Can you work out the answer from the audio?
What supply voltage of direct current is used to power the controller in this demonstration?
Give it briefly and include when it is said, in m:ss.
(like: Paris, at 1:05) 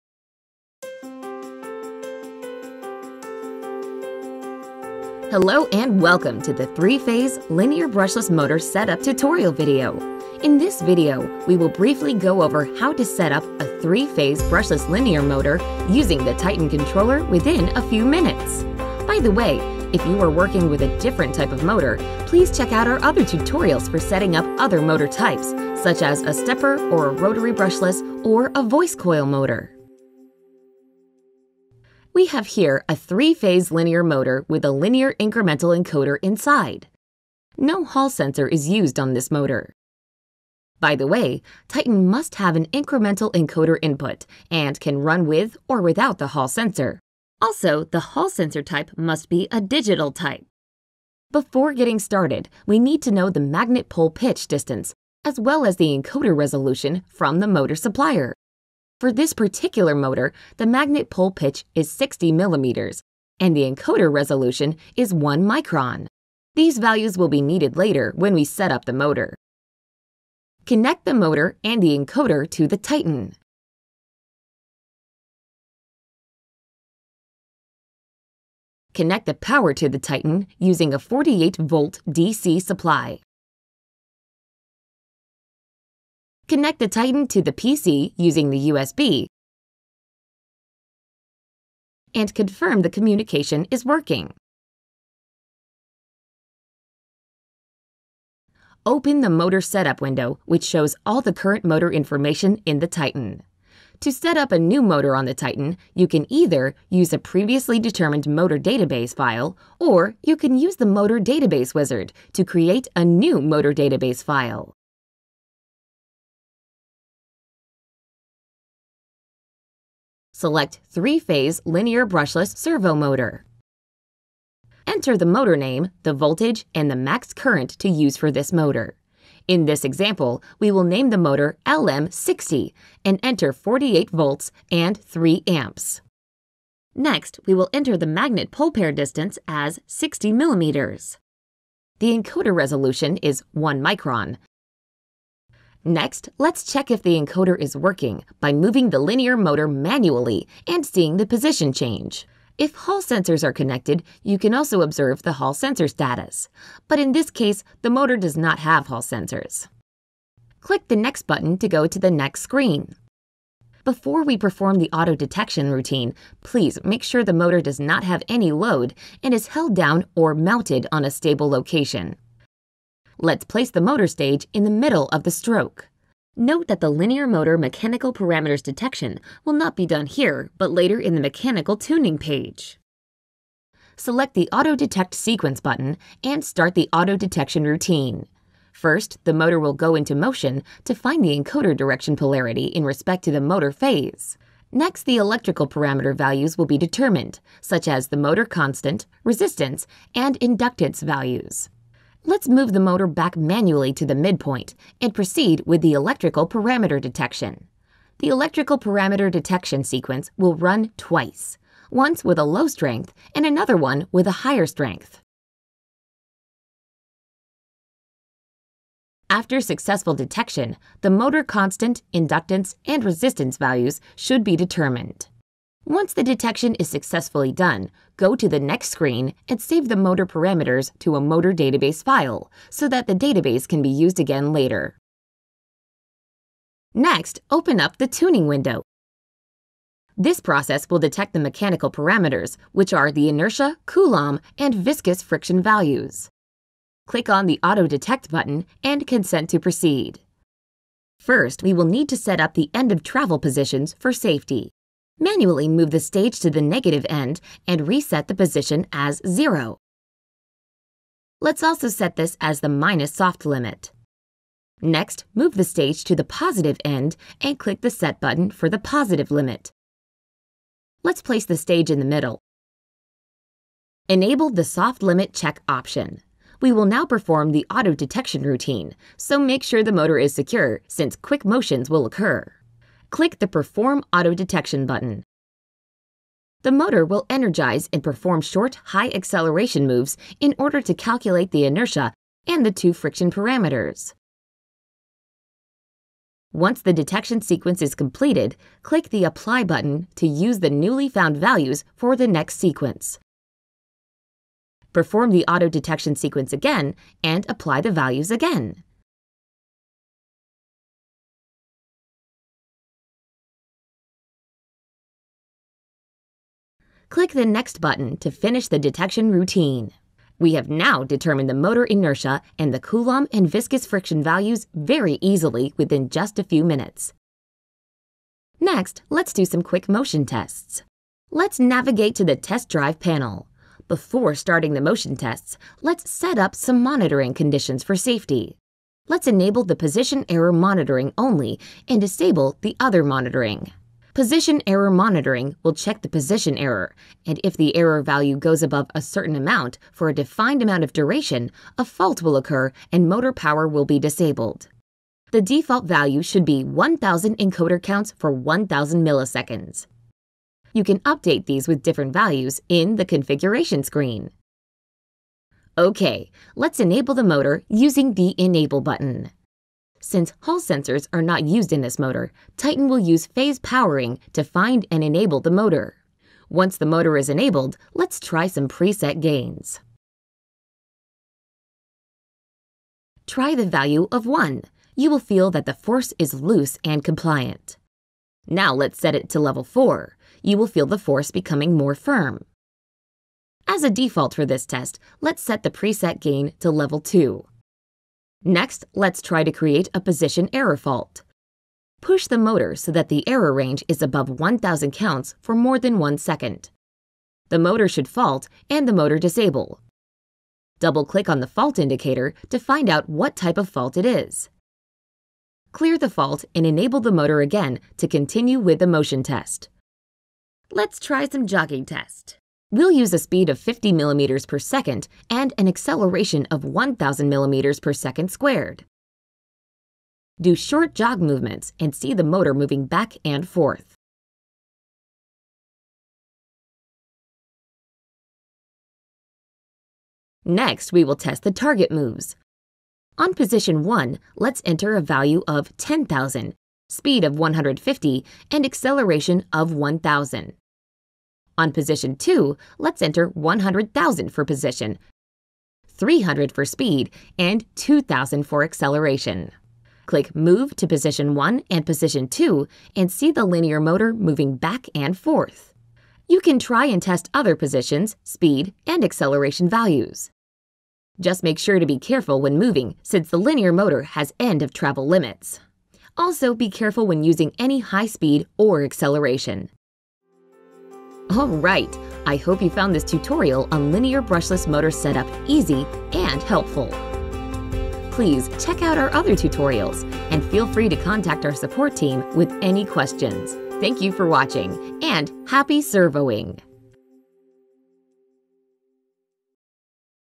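48-volt, at 1:20.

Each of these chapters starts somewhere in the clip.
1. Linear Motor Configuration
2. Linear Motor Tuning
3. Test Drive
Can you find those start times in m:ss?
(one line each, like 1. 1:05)
1. 0:30
2. 3:55
3. 5:28.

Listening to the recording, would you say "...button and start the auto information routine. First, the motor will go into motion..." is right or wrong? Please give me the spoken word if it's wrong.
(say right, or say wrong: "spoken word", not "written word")
wrong: "detection", not "information".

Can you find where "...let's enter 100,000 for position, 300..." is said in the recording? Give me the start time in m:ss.
7:32.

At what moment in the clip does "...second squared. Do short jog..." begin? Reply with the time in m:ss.
7:07.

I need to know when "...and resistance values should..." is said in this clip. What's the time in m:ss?
3:42.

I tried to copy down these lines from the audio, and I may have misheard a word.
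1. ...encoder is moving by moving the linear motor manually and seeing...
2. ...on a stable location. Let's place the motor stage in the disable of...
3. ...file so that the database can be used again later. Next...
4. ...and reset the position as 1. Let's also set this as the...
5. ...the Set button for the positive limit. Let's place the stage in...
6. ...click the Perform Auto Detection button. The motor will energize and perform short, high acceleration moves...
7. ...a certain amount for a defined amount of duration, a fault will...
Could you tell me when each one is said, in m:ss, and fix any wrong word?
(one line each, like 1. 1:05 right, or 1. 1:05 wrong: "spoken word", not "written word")
1. 2:27 wrong: "working", not "moving"
2. 2:50 wrong: "middle", not "disable"
3. 3:52 right
4. 4:17 wrong: "0", not "1"
5. 4:27 right
6. 4:43 right
7. 5:48 right.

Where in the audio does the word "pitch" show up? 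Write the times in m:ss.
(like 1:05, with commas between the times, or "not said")
0:54, 1:01.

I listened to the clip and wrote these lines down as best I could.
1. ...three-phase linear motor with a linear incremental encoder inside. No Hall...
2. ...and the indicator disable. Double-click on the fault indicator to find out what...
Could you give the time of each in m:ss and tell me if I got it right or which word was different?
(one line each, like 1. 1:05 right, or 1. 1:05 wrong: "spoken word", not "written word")
1. 0:32 right
2. 6:48 wrong: "motor", not "indicator".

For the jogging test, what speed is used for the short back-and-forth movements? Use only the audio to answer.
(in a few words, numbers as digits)
50 millimeters per second.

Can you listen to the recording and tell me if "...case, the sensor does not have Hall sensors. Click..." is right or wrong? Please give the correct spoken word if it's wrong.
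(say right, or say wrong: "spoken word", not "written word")
wrong: "motor", not "sensor".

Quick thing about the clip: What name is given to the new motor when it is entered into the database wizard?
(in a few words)
LM60.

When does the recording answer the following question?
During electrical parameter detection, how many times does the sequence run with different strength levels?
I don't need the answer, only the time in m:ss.
3:30.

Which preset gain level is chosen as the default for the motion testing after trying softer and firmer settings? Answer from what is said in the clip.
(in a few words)
level 2.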